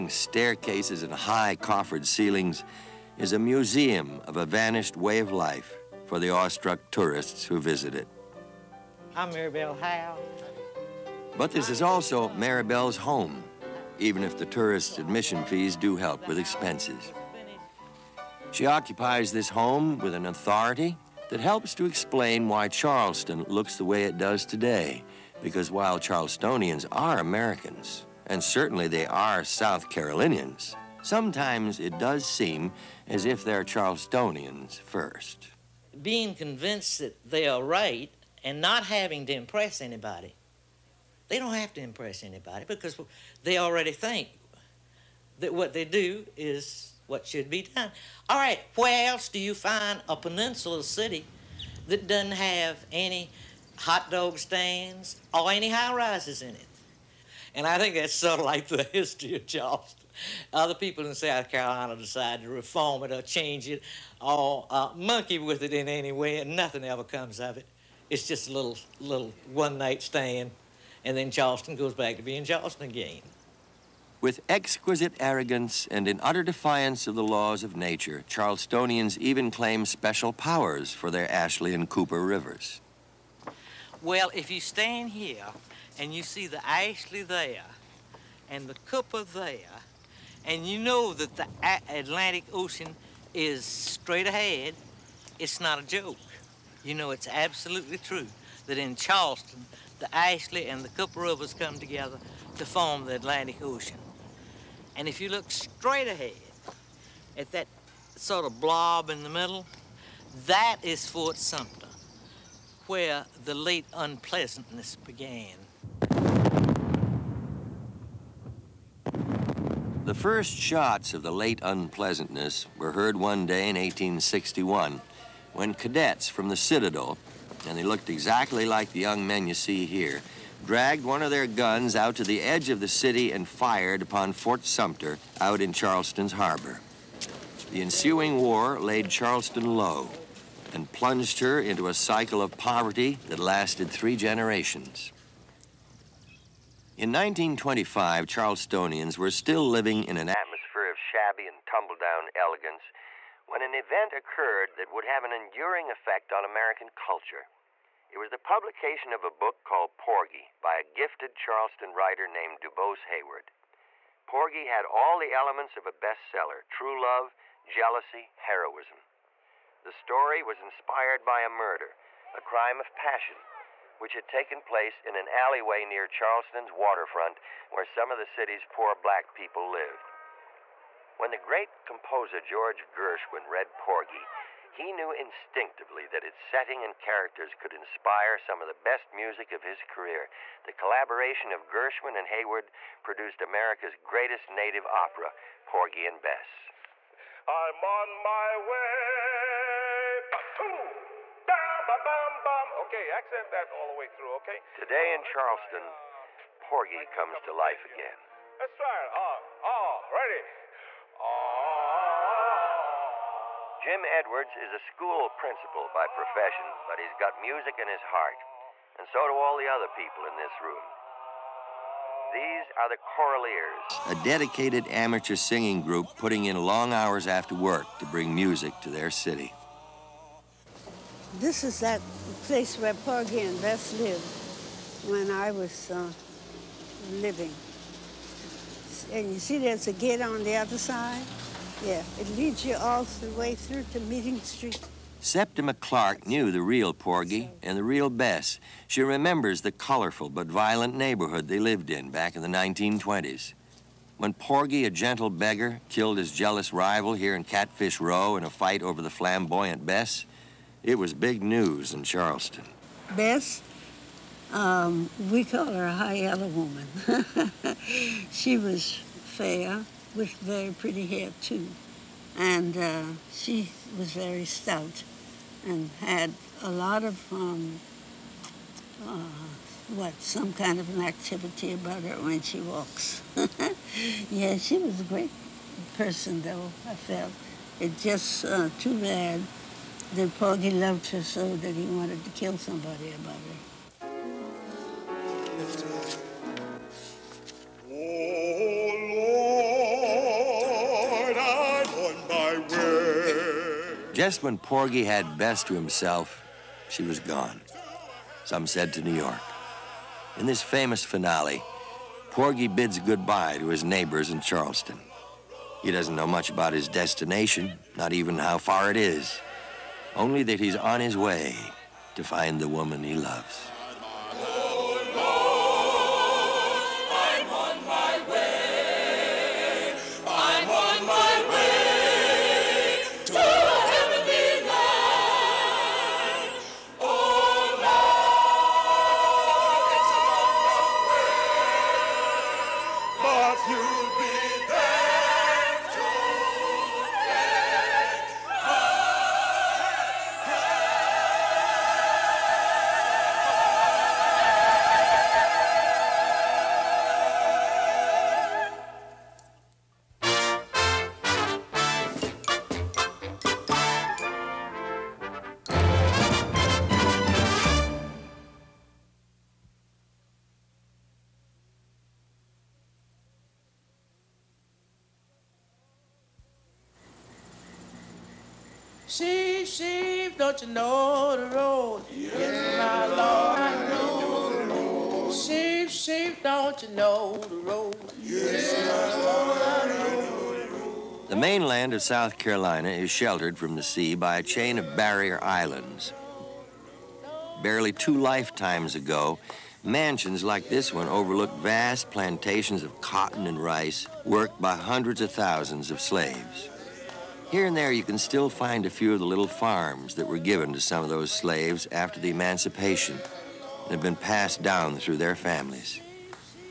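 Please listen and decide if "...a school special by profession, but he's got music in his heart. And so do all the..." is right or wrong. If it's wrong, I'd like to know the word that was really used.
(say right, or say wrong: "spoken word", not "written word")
wrong: "principal", not "special".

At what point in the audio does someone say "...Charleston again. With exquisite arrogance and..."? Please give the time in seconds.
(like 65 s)
72 s.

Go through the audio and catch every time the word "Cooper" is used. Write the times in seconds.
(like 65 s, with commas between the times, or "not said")
81 s, 88 s, 100 s.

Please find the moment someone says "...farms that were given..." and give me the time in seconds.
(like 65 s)
409 s.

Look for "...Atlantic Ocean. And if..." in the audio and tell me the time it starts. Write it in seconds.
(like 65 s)
103 s.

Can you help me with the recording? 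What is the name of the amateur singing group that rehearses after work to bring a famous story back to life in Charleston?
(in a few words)
the Choraliers.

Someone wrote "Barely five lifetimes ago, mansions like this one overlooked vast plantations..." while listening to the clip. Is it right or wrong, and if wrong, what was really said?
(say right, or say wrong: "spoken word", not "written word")
wrong: "two", not "five".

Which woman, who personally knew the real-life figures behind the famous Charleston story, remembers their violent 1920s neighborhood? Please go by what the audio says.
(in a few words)
Septima Clark.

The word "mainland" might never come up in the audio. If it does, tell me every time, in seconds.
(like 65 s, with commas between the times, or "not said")
391 s.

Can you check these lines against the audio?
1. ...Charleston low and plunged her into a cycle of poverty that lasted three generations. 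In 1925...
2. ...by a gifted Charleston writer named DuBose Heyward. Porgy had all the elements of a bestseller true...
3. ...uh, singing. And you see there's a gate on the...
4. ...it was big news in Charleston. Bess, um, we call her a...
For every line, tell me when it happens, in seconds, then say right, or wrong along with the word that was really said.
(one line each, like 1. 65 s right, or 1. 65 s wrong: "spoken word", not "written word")
1. 139 s right
2. 160 s right
3. 235 s wrong: "living", not "singing"
4. 260 s right.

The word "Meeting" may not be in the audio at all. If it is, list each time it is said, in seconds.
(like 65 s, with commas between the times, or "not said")
243 s.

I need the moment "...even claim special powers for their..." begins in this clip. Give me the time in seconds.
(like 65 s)
79 s.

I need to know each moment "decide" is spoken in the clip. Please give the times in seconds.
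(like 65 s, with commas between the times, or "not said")
61 s.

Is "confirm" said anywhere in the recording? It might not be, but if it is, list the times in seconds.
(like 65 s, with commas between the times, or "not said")
not said.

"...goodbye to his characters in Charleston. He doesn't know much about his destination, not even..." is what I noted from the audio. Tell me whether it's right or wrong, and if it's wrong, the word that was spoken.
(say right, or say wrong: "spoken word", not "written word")
wrong: "neighbors", not "characters".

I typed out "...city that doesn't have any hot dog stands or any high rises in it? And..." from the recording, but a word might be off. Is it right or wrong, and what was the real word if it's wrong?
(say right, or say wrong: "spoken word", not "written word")
right.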